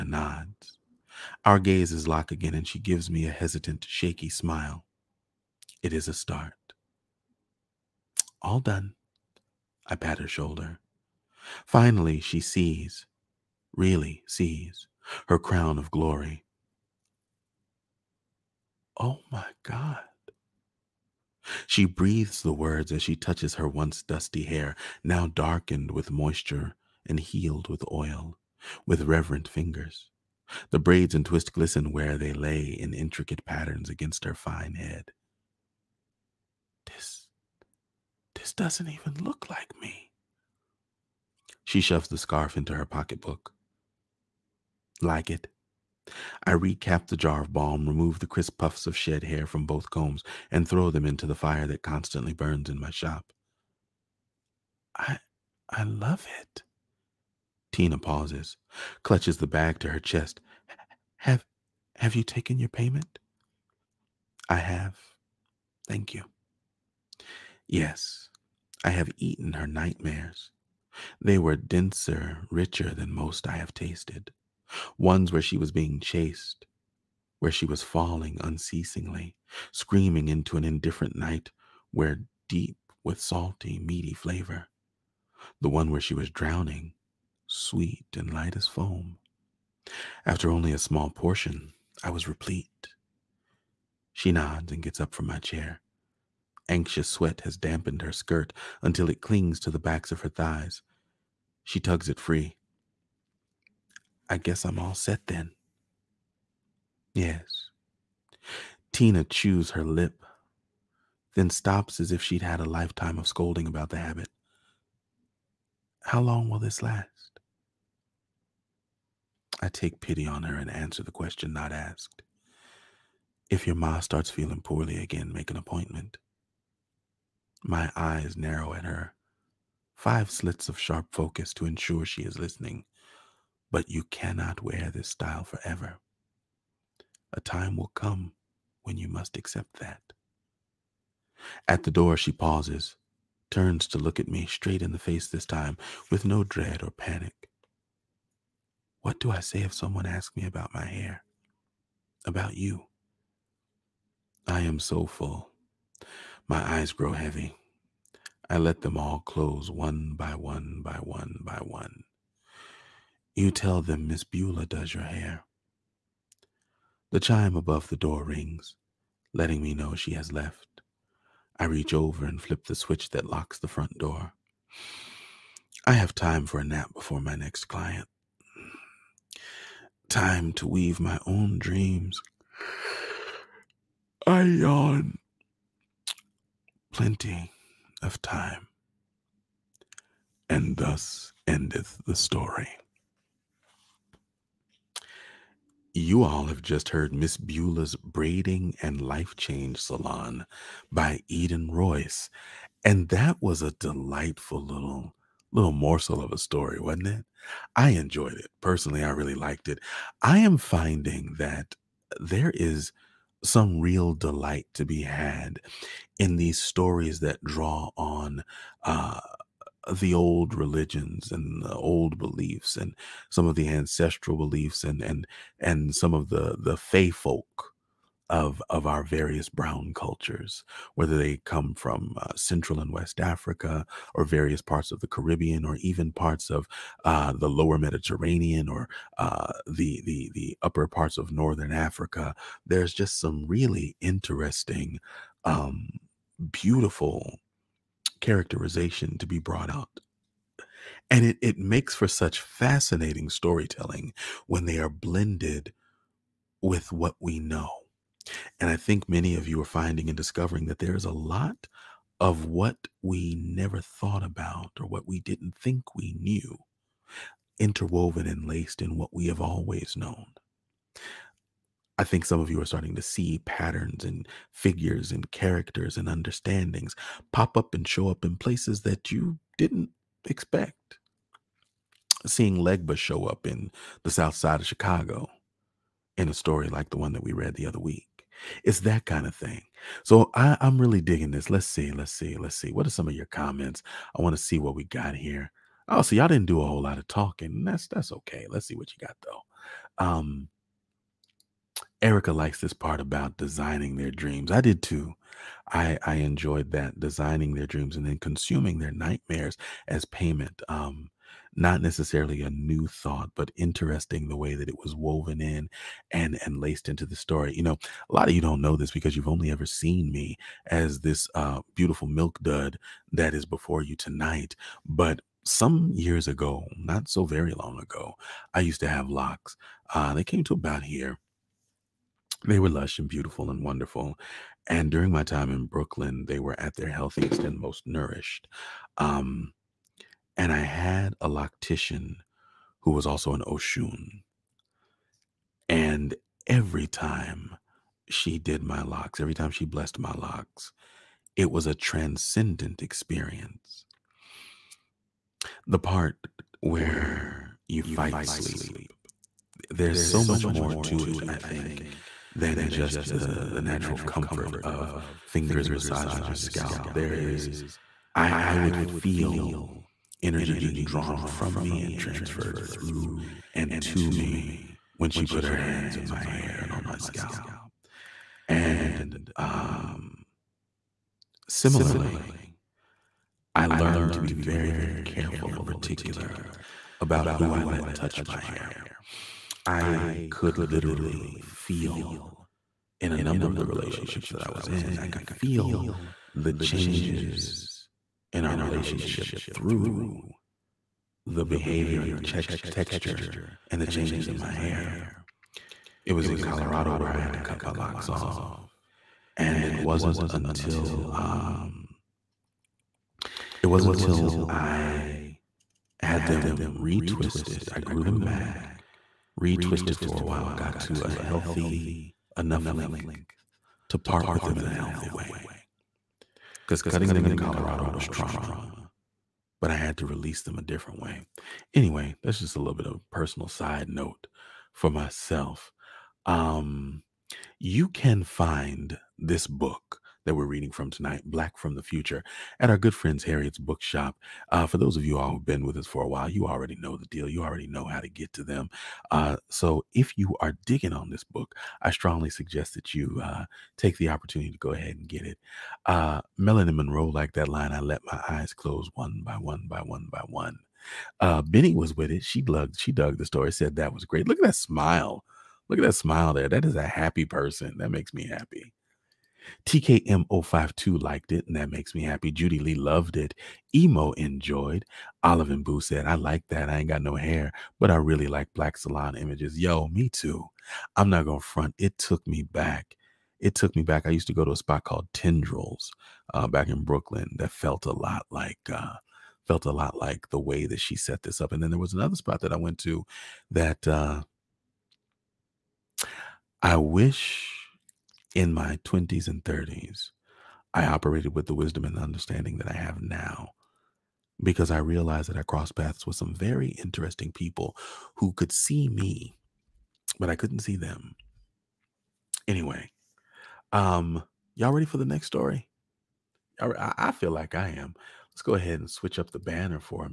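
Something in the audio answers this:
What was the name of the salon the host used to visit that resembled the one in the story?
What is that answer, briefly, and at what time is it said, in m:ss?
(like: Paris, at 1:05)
Tendrils, at 8:05.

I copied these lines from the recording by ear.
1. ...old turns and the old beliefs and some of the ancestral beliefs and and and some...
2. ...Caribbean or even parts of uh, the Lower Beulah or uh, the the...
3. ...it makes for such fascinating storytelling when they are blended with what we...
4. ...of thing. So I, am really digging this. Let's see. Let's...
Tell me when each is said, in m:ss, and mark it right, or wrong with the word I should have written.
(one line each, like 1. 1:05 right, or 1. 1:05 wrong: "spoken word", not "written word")
1. 3:40 wrong: "religions", not "turns"
2. 3:55 wrong: "Mediterranean", not "Beulah"
3. 4:11 right
4. 4:49 right.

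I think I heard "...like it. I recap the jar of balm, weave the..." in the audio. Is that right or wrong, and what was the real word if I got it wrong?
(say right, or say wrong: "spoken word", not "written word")
wrong: "remove", not "weave".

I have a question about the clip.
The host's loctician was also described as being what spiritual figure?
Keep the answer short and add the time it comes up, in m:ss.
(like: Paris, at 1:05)
Oshun, at 5:43.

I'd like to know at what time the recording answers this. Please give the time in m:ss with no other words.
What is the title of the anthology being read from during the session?
7:21.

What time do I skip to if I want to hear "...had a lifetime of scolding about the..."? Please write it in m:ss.
1:52.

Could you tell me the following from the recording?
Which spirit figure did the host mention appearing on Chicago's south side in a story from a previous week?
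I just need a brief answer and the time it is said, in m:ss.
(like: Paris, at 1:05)
Legba, at 4:42.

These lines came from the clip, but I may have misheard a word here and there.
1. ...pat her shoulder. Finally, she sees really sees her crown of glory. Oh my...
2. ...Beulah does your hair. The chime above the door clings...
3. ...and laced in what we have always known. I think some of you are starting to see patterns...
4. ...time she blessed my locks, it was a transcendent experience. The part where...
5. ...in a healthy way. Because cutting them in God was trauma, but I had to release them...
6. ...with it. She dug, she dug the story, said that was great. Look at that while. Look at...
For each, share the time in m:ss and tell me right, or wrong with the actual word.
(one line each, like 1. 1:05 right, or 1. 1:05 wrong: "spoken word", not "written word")
1. 0:09 right
2. 2:44 wrong: "rings", not "clings"
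3. 4:28 right
4. 5:49 right
5. 7:04 wrong: "Colorado", not "God"
6. 7:41 wrong: "smile", not "while".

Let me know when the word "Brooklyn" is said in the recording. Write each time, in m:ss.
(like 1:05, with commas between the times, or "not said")
5:35, 8:06.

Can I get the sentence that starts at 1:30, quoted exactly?
After only a small portion, I was replete.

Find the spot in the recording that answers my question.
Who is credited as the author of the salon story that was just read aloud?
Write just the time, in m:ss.
3:21.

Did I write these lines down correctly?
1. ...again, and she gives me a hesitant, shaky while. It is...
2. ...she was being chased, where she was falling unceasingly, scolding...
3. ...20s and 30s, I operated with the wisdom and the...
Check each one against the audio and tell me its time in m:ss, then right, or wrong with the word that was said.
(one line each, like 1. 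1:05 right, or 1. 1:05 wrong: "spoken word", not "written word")
1. 0:02 wrong: "smile", not "while"
2. 1:15 wrong: "screaming", not "scolding"
3. 8:18 right.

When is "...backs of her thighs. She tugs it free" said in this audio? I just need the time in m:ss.
1:39.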